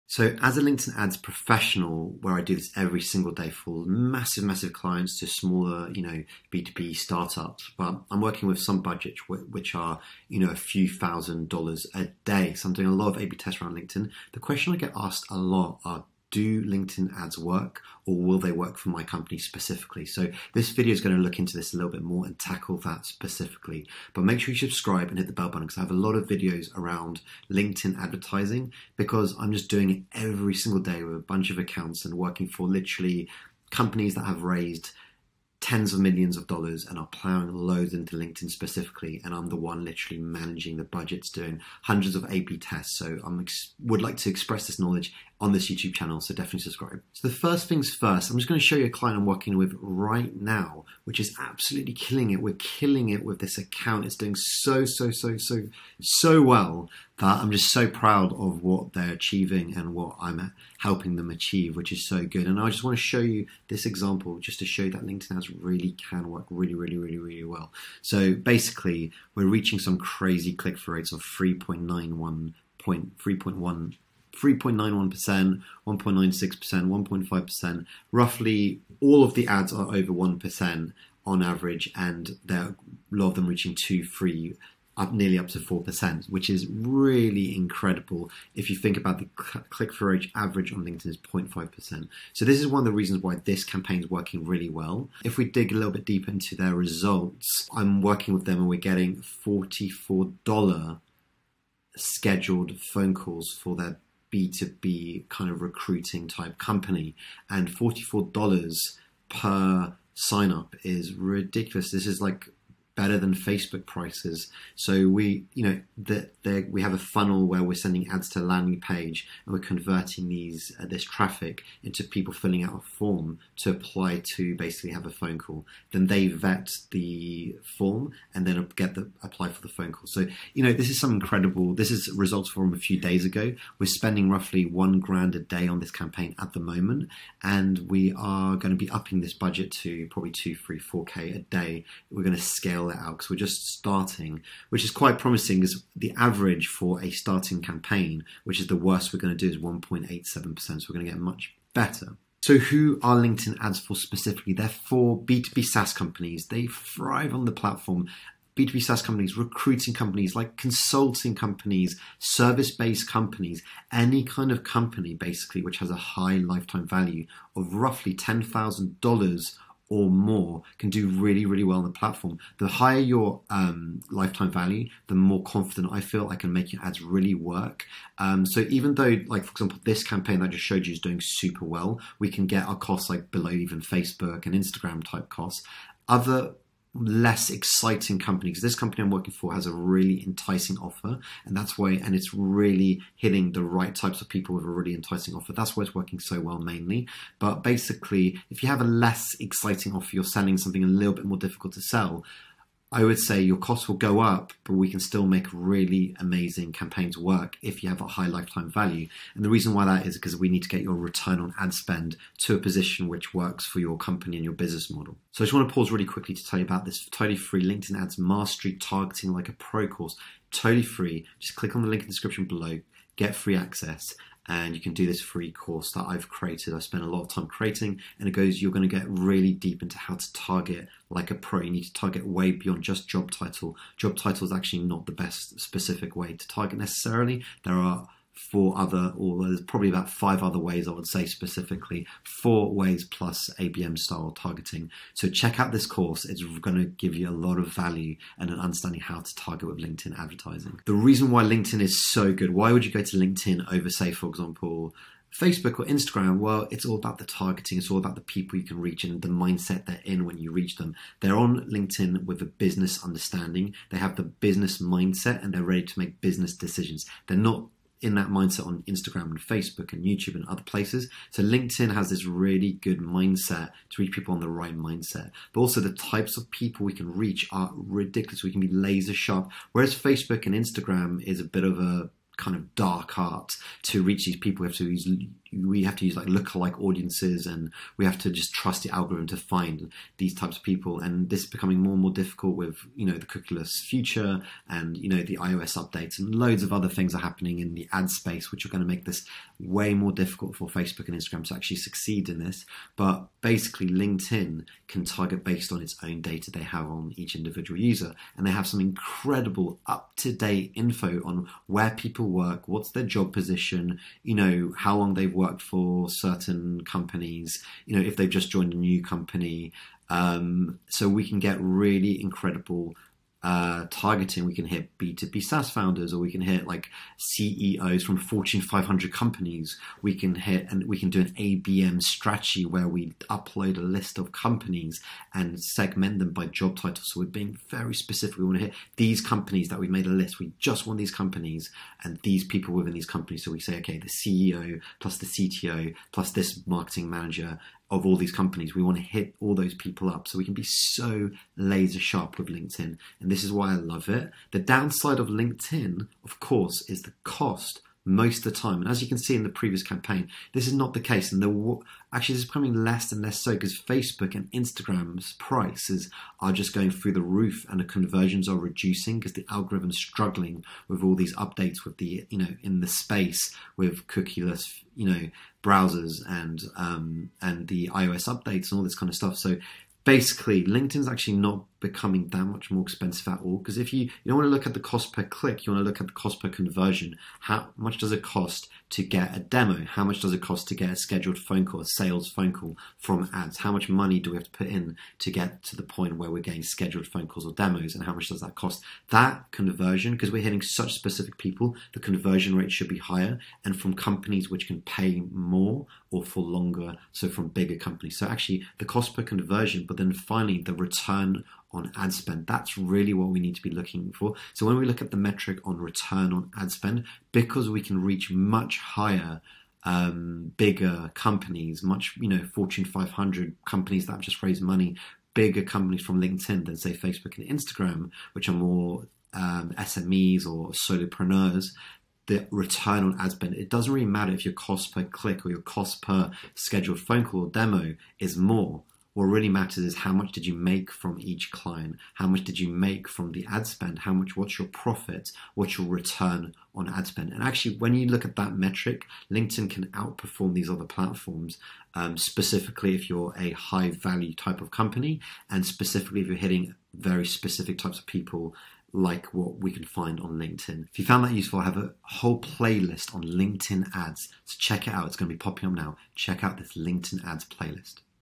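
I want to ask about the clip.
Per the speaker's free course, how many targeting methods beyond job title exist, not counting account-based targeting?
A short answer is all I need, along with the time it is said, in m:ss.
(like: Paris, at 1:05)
4, at 4:02.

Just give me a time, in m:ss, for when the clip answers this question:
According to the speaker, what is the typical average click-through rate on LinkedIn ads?
1:31.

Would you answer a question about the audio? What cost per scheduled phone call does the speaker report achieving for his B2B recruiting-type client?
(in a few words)
$44.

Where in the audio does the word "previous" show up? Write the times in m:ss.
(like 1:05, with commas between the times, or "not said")
5:59.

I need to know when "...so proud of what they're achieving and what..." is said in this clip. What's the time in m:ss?
0:57.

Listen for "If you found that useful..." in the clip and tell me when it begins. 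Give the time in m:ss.
7:40.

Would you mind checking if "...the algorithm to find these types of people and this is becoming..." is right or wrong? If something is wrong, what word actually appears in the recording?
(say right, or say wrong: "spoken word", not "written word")
right.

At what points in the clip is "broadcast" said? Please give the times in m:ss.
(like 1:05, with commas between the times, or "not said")
not said.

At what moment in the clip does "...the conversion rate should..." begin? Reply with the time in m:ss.
6:41.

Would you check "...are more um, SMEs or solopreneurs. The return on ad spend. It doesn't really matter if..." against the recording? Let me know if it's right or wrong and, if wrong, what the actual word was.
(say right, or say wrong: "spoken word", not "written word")
right.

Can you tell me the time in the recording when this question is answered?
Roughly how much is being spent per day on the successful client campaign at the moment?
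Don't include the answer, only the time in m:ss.
2:14.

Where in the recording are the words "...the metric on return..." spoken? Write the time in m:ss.
6:55.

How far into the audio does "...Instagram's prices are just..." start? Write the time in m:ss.
6:04.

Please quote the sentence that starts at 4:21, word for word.
They're on LinkedIn with a business understanding.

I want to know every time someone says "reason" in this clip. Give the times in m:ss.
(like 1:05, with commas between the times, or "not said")
1:32, 3:29, 4:10.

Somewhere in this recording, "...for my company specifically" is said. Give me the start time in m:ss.
0:18.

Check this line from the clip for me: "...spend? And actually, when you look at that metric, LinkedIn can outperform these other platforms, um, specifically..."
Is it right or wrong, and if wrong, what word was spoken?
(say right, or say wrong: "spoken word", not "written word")
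right.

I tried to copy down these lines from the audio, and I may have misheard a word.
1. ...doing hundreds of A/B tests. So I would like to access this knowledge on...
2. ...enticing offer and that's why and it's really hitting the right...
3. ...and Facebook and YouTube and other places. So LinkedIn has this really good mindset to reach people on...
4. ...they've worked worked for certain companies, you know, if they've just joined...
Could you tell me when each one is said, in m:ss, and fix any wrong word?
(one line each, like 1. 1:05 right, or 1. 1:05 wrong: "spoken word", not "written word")
1. 0:41 wrong: "express", not "access"
2. 3:10 right
3. 4:29 right
4. 5:15 right.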